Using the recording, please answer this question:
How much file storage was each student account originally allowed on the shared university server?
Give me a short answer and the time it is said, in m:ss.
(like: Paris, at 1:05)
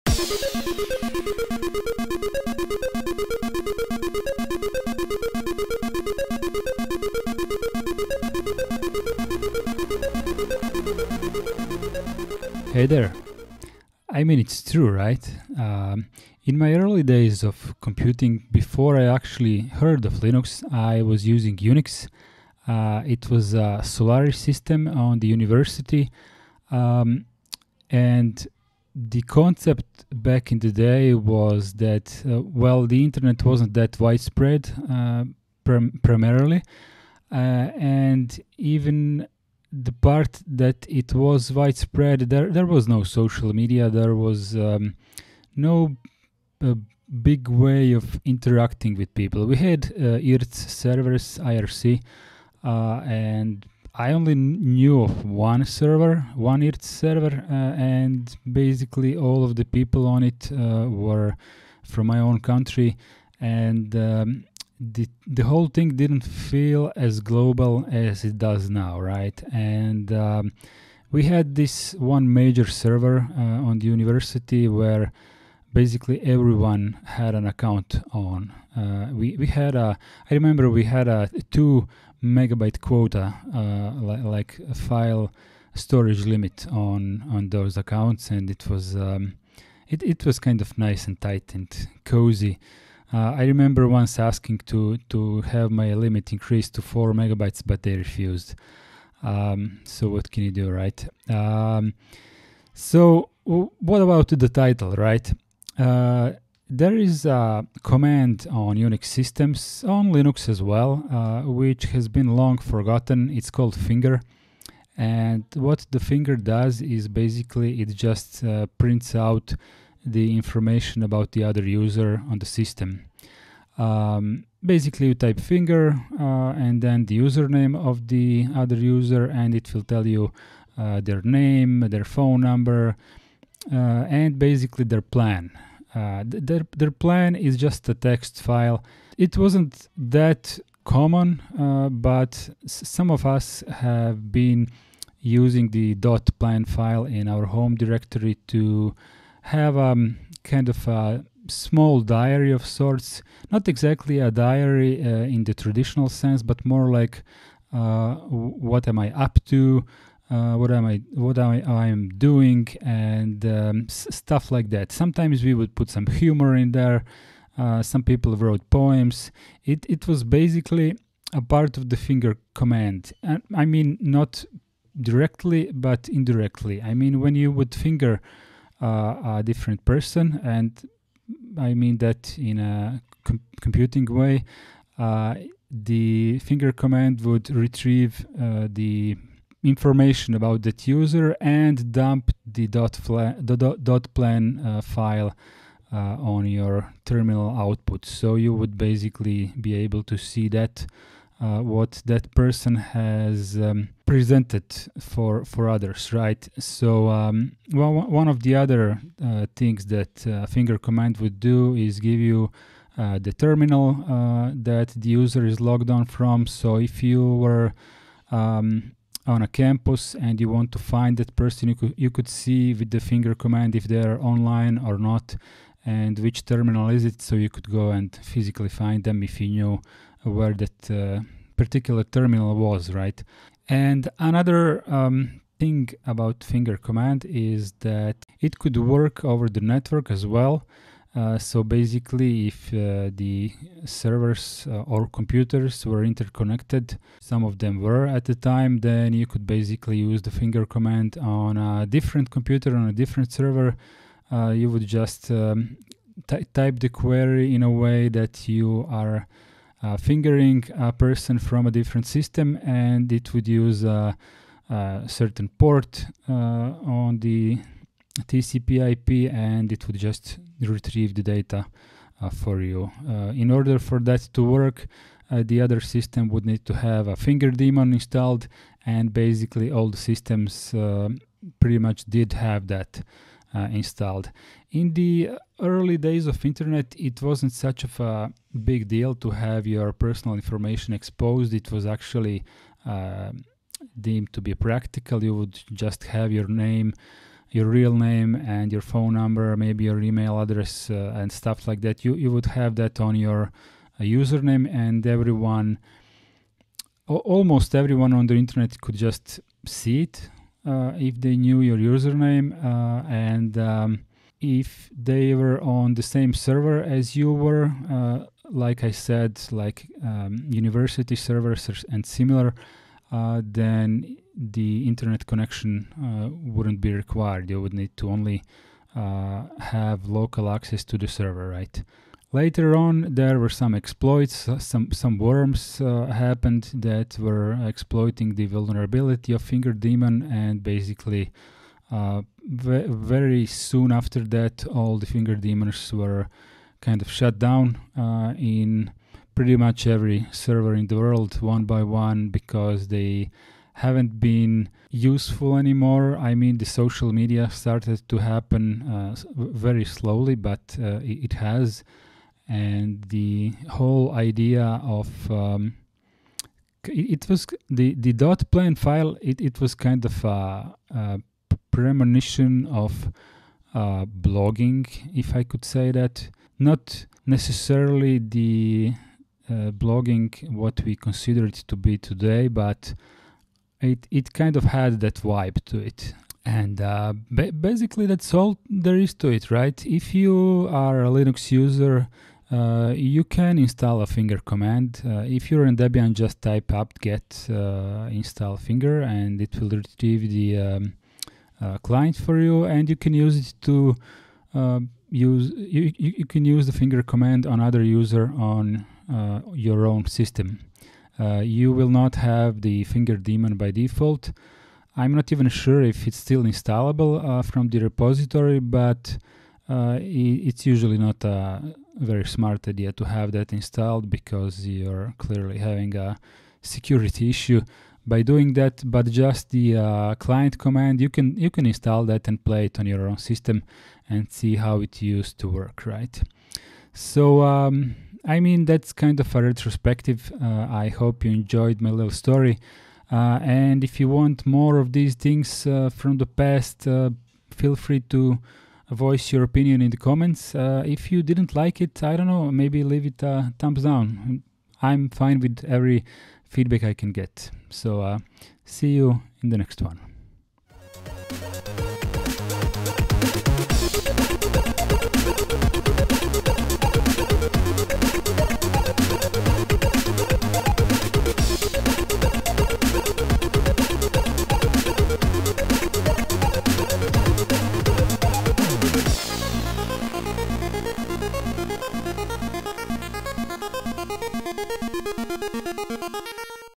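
2 megabytes, at 1:21.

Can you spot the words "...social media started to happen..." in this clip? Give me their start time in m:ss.
5:56.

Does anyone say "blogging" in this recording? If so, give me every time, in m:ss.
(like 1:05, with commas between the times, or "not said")
6:14, 6:19.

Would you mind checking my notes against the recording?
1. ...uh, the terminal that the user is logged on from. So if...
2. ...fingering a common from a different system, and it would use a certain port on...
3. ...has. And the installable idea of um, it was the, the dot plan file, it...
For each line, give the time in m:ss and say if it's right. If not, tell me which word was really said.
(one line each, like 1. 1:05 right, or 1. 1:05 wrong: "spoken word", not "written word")
1. 3:32 right
2. 4:19 wrong: "person", not "common"
3. 6:01 wrong: "whole", not "installable".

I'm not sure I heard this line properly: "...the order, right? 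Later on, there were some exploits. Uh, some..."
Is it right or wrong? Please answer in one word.
wrong.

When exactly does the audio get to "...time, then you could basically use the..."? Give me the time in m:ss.
4:08.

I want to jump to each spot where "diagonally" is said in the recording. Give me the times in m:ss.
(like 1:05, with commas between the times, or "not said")
not said.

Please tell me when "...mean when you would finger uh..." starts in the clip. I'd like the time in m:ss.
2:56.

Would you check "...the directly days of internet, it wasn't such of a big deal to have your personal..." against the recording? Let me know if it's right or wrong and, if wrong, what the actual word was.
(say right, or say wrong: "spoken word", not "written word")
wrong: "early", not "directly".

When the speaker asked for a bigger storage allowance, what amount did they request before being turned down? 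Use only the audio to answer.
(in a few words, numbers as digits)
4 megabytes.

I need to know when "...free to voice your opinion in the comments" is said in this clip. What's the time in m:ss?
7:27.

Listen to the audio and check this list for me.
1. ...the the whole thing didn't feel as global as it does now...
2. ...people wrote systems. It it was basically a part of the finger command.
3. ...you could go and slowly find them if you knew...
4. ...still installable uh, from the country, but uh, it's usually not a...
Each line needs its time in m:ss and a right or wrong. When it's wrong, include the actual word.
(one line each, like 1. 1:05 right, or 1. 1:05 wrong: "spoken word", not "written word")
1. 1:04 right
2. 2:48 wrong: "poems", not "systems"
3. 3:47 wrong: "physically", not "slowly"
4. 6:56 wrong: "repository", not "country".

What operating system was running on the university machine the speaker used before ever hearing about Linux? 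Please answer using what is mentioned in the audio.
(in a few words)
Solaris.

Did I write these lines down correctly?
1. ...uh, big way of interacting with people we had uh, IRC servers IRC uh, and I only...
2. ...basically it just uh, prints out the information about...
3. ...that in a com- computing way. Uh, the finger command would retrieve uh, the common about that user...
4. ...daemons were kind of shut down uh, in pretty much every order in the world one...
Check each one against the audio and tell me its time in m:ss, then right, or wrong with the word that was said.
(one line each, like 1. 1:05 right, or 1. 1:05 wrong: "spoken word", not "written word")
1. 0:46 right
2. 1:57 right
3. 3:01 wrong: "information", not "common"
4. 5:45 wrong: "server", not "order".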